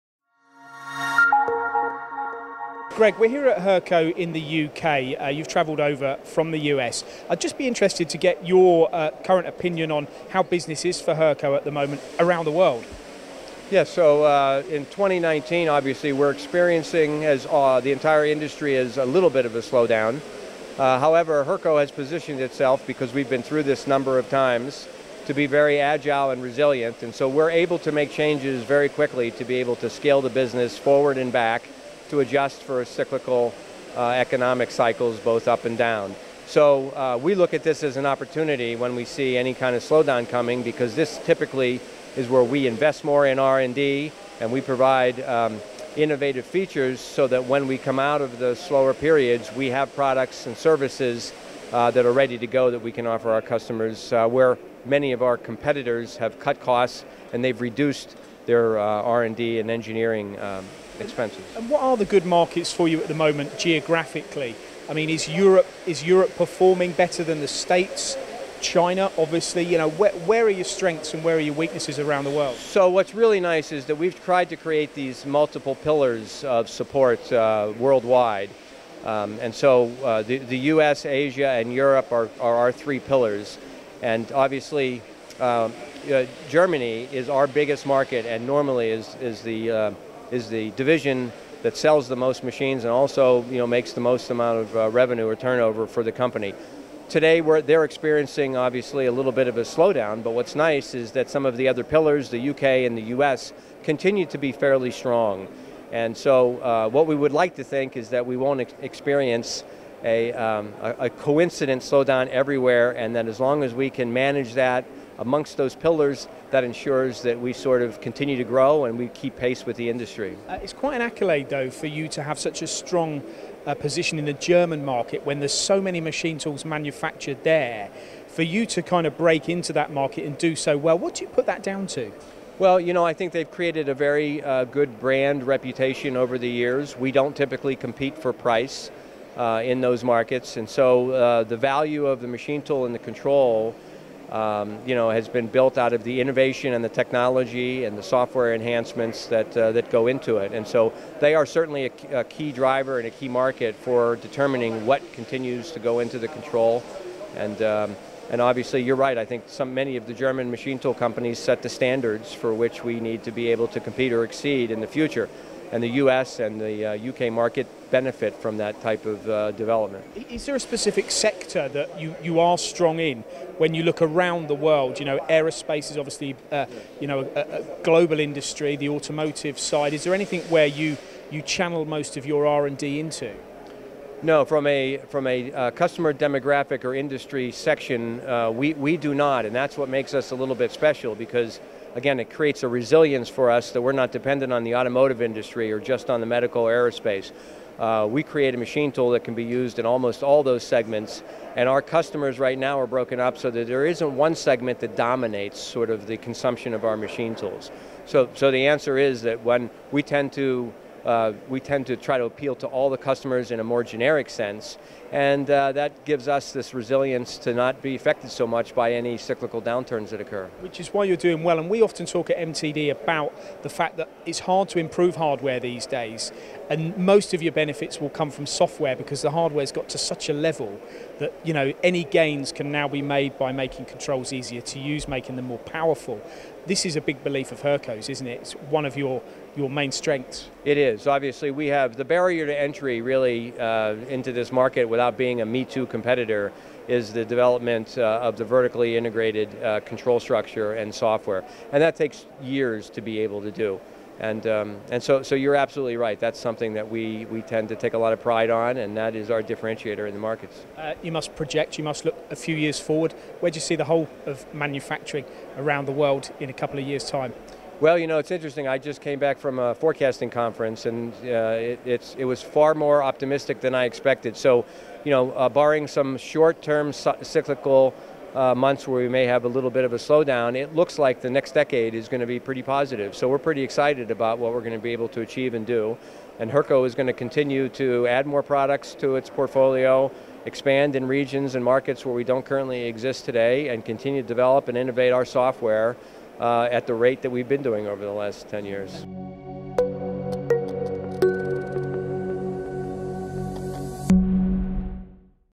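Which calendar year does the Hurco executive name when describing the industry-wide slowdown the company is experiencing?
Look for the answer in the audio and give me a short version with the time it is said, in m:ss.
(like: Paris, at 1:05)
2019, at 0:14.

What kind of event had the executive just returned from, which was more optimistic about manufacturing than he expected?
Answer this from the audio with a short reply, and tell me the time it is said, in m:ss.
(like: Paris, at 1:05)
forecasting conference, at 4:29.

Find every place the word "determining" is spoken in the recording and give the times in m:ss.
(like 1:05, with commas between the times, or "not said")
2:34.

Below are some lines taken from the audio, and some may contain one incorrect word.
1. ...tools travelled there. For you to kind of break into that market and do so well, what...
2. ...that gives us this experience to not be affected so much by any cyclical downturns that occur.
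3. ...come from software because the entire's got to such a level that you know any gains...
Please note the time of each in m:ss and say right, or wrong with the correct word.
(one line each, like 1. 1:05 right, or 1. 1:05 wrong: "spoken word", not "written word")
1. 2:06 wrong: "manufactured", not "travelled"
2. 3:35 wrong: "resilience", not "experience"
3. 3:48 wrong: "hardware", not "entire".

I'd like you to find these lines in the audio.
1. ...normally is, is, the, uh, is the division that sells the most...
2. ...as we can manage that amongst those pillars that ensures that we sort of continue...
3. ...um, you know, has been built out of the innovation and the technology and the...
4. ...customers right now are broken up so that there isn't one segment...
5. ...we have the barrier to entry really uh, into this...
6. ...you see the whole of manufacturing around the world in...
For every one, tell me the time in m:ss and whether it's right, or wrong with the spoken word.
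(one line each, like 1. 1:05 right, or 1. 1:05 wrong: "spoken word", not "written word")
1. 1:28 right
2. 1:53 right
3. 2:24 right
4. 3:21 right
5. 4:01 right
6. 4:23 right.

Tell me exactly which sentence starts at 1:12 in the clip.
So what's really nice is that we've tried to create these multiple pillars of support uh, worldwide.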